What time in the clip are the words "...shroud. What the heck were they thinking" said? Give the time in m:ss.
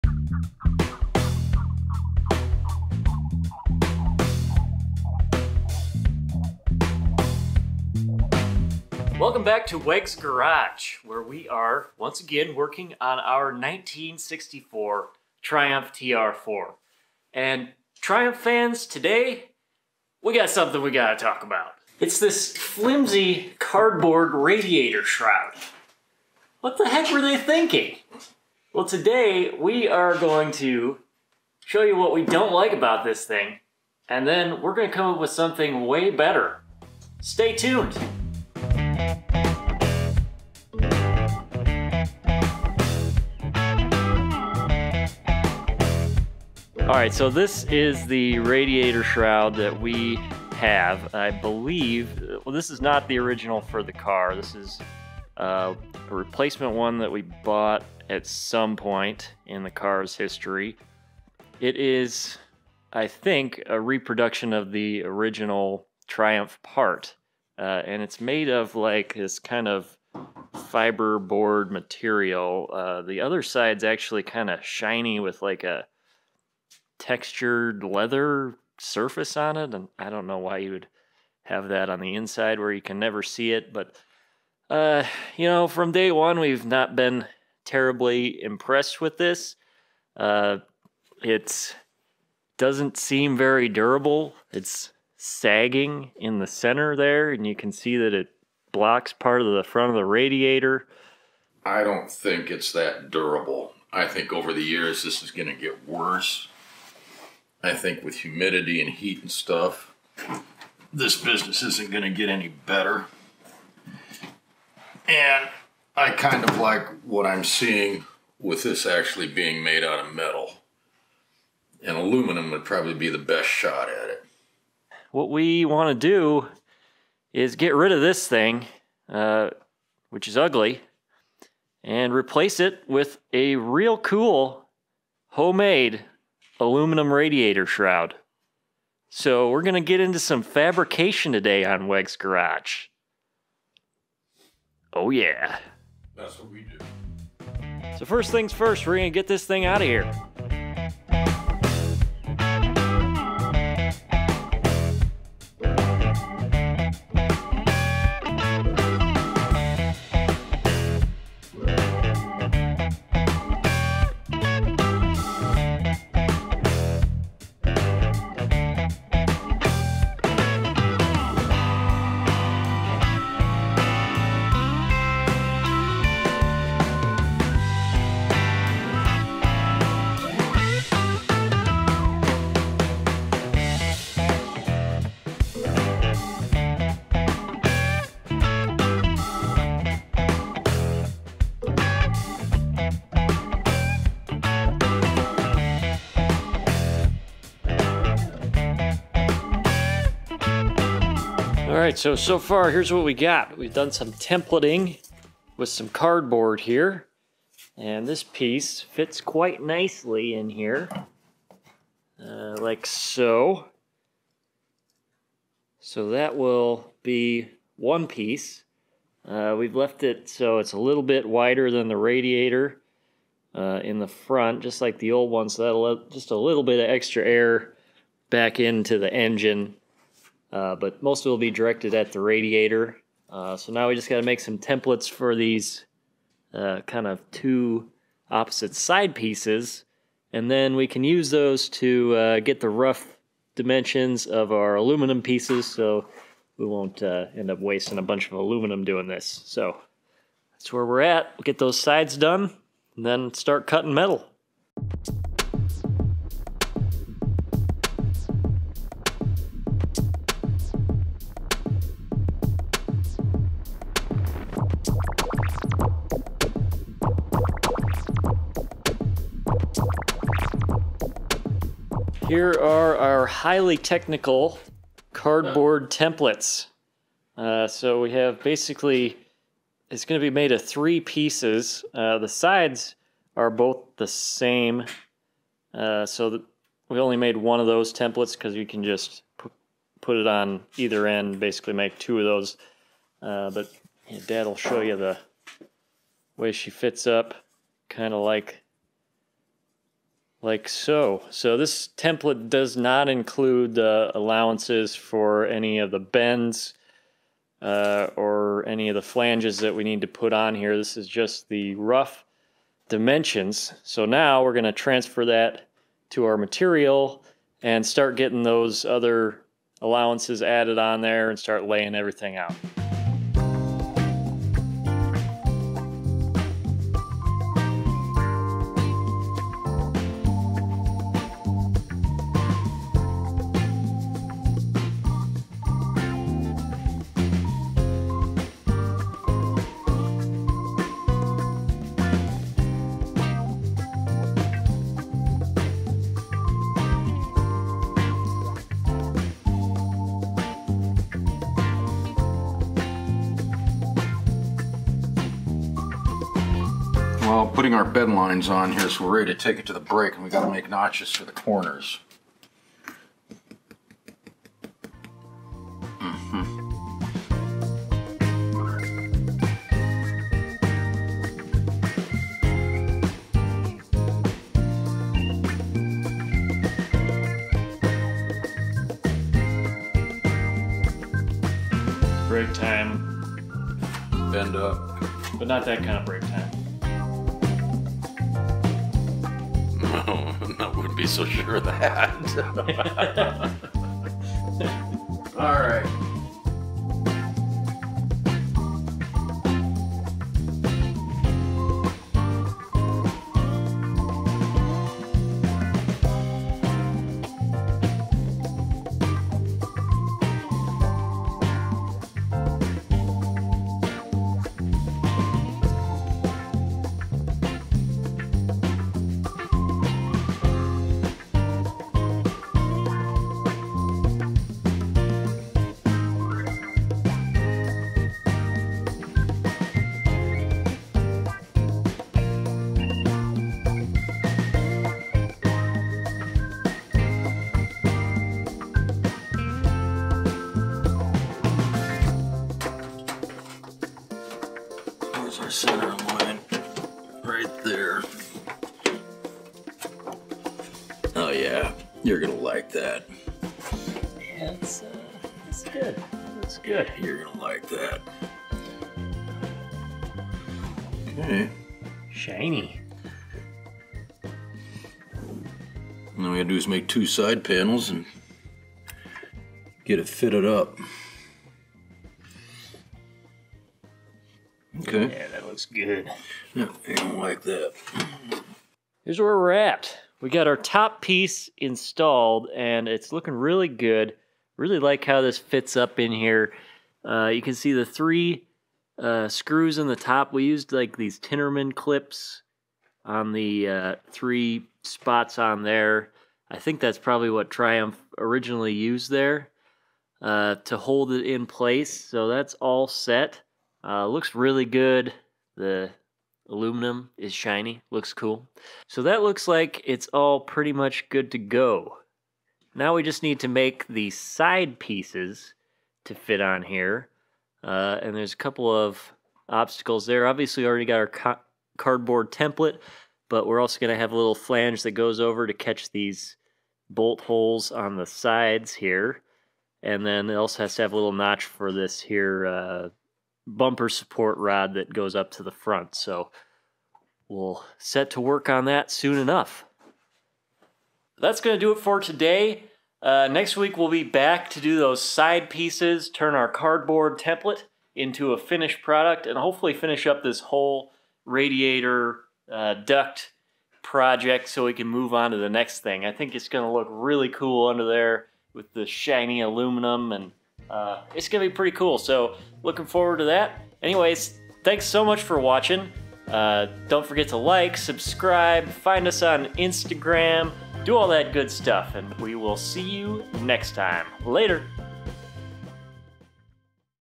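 0:25.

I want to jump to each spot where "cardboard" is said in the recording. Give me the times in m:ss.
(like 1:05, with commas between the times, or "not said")
0:23, 3:25, 4:35, 8:41, 9:06.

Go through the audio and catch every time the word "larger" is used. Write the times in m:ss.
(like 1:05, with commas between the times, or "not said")
not said.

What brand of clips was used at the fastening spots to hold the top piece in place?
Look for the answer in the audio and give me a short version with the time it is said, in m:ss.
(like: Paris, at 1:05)
Tinnerman, at 8:11.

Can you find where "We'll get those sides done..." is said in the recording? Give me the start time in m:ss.
4:11.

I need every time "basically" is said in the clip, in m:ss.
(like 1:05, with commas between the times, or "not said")
4:38, 4:51.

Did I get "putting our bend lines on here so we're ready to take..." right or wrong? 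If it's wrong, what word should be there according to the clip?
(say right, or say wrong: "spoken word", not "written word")
right.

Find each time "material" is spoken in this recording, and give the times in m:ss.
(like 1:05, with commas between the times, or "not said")
1:11, 5:16.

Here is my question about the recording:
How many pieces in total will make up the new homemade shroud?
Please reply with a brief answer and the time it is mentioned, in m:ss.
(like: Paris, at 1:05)
3, at 4:40.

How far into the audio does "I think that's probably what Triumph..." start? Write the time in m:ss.
8:16.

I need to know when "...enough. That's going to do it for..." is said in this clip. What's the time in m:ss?
8:59.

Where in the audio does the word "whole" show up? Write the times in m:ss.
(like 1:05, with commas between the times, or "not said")
9:10.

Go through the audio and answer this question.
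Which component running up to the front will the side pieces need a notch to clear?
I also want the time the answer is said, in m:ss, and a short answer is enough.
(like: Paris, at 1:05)
bumper support rod, at 8:53.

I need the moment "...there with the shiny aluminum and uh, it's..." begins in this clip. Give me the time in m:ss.
9:17.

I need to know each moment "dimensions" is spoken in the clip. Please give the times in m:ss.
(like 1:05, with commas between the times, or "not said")
4:03, 5:12.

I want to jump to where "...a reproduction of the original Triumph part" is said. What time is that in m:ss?
1:03.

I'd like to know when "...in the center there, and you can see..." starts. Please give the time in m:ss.
1:36.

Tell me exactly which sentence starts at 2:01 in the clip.
And aluminum would probably be the best shot at it.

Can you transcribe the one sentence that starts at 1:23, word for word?
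But uh, you know, from day one, we've not been terribly impressed with this.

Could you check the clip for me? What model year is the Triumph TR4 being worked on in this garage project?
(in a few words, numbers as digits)
1964.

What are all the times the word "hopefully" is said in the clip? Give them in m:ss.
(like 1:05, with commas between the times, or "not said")
9:09.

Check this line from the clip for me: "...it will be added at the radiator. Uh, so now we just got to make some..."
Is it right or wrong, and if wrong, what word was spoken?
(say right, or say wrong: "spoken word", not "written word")
wrong: "directed", not "added".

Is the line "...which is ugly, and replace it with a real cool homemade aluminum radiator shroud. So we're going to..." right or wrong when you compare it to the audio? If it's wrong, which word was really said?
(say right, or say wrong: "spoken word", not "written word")
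right.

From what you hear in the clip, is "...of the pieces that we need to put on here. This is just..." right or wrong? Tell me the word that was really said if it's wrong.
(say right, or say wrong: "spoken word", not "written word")
wrong: "flanges", not "pieces".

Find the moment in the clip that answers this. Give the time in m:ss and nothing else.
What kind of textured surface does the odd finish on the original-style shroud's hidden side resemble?
1:17.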